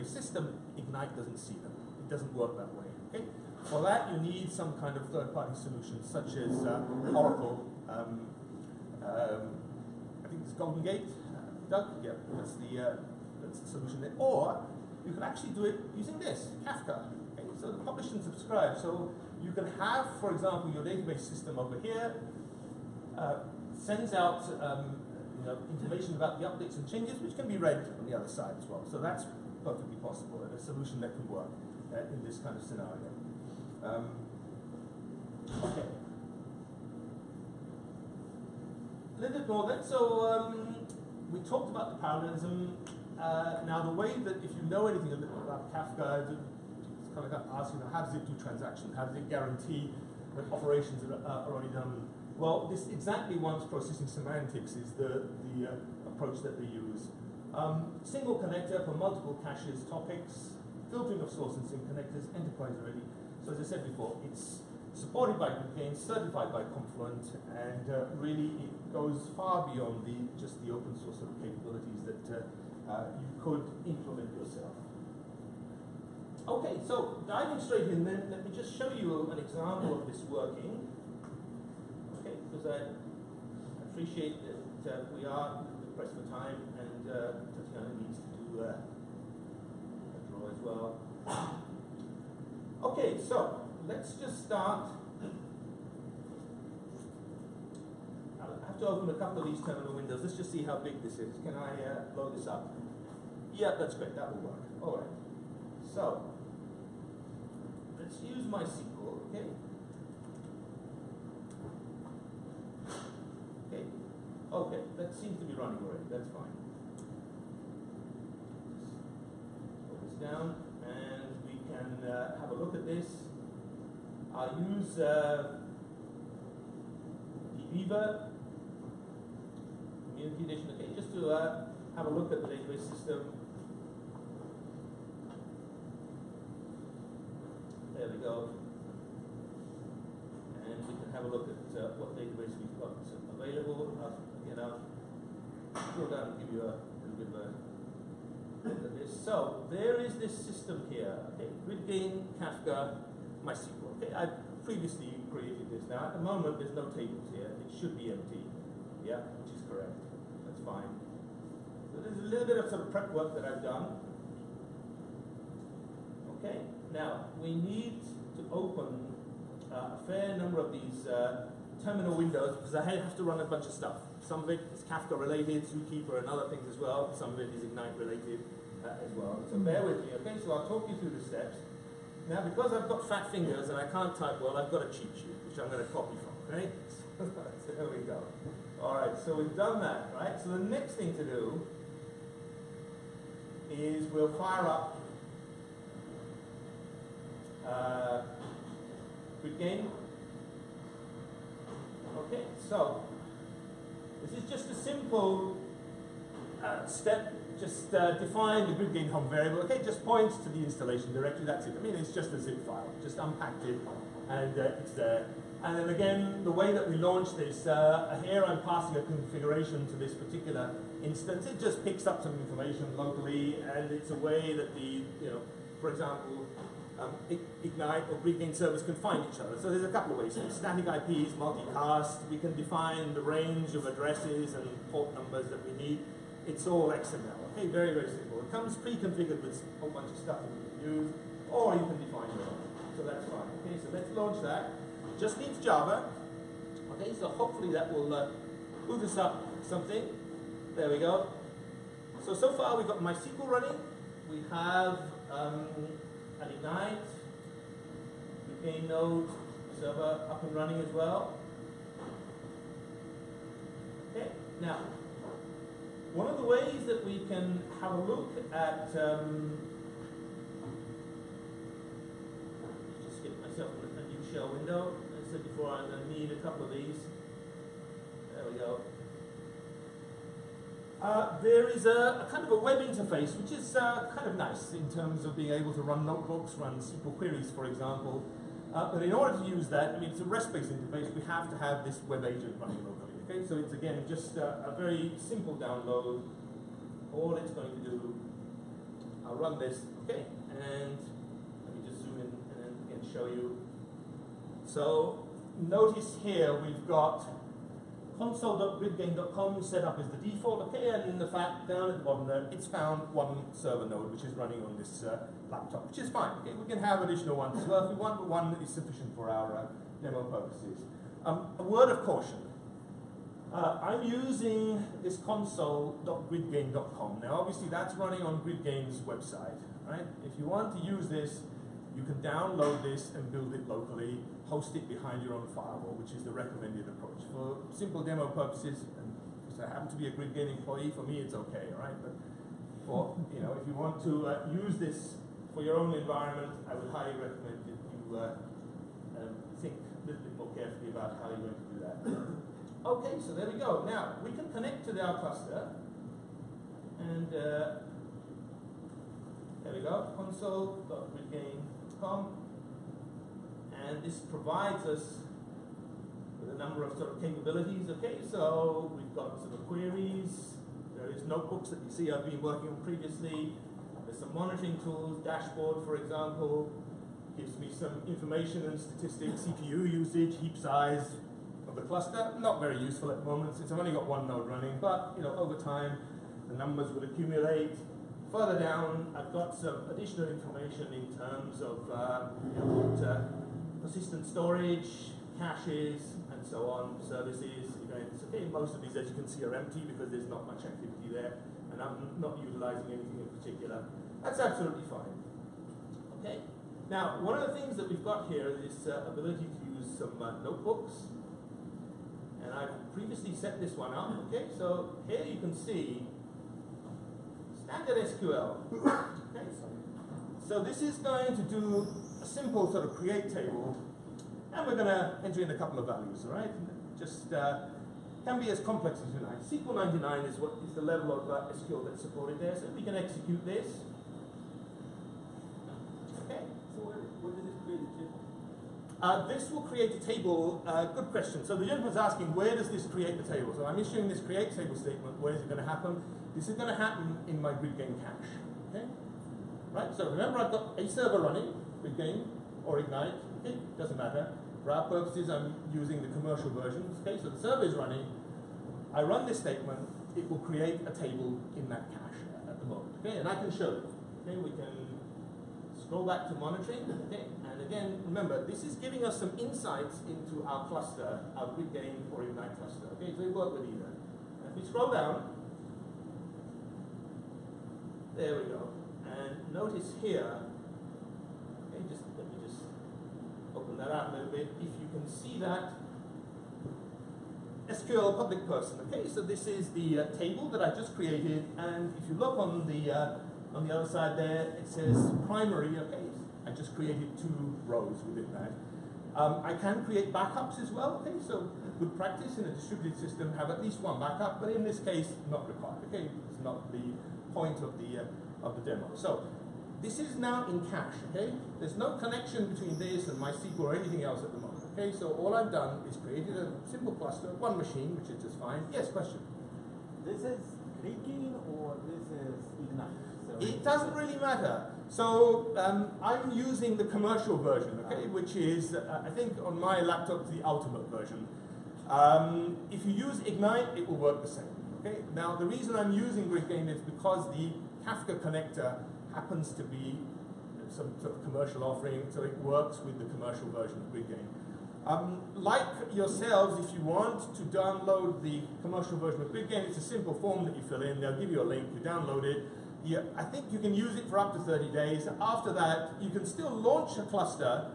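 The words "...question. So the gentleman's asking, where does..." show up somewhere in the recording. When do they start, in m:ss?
7:21.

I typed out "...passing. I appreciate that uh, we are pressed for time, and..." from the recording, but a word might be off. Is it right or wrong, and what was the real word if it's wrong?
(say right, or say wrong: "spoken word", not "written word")
wrong: "working", not "passing".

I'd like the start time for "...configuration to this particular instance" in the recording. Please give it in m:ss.
3:39.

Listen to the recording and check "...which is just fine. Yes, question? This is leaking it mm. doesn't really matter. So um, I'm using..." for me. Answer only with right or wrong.
right.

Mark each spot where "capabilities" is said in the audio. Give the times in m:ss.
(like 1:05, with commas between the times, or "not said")
1:11, 6:07.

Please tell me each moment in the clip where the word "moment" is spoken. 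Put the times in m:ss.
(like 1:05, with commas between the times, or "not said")
2:36, 6:23, 7:42, 8:34.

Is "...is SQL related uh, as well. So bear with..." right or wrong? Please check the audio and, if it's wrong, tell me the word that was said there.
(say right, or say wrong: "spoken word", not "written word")
wrong: "Ignite", not "SQL".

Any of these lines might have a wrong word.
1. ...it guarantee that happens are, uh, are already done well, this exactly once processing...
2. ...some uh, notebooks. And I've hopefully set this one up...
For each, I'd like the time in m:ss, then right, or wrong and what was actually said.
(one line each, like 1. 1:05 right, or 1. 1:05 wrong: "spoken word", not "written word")
1. 0:49 wrong: "operations", not "happens"
2. 6:49 wrong: "previously", not "hopefully".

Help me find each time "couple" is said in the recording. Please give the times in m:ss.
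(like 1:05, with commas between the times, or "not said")
1:39, 3:49, 4:36, 7:05.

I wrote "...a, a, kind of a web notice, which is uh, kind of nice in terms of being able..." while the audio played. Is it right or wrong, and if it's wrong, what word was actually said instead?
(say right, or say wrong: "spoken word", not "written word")
wrong: "interface", not "notice".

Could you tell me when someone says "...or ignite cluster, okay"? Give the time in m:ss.
7:52.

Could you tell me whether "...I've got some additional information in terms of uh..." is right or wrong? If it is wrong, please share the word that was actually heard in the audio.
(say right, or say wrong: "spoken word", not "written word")
right.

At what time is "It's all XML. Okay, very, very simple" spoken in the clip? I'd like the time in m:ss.
3:56.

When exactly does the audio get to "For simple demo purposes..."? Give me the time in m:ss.
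5:37.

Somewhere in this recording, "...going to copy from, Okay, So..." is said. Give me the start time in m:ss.
3:05.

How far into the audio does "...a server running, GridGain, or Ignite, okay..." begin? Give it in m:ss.
7:30.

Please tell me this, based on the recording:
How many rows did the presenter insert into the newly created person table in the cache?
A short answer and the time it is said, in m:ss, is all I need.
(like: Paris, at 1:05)
2, at 8:17.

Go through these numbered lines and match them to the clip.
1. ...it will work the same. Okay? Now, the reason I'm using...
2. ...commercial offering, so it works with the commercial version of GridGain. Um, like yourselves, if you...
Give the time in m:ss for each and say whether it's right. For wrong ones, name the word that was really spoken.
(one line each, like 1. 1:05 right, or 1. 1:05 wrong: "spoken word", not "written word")
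1. 8:53 right
2. 9:01 right.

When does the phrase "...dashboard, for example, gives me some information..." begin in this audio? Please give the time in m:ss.
6:15.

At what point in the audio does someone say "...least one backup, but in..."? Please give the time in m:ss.
8:23.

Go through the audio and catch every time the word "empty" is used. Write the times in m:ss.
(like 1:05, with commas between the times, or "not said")
2:38, 6:39.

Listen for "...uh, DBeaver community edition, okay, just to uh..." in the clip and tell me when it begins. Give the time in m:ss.
2:04.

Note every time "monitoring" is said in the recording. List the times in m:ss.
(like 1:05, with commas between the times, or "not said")
6:14, 7:46.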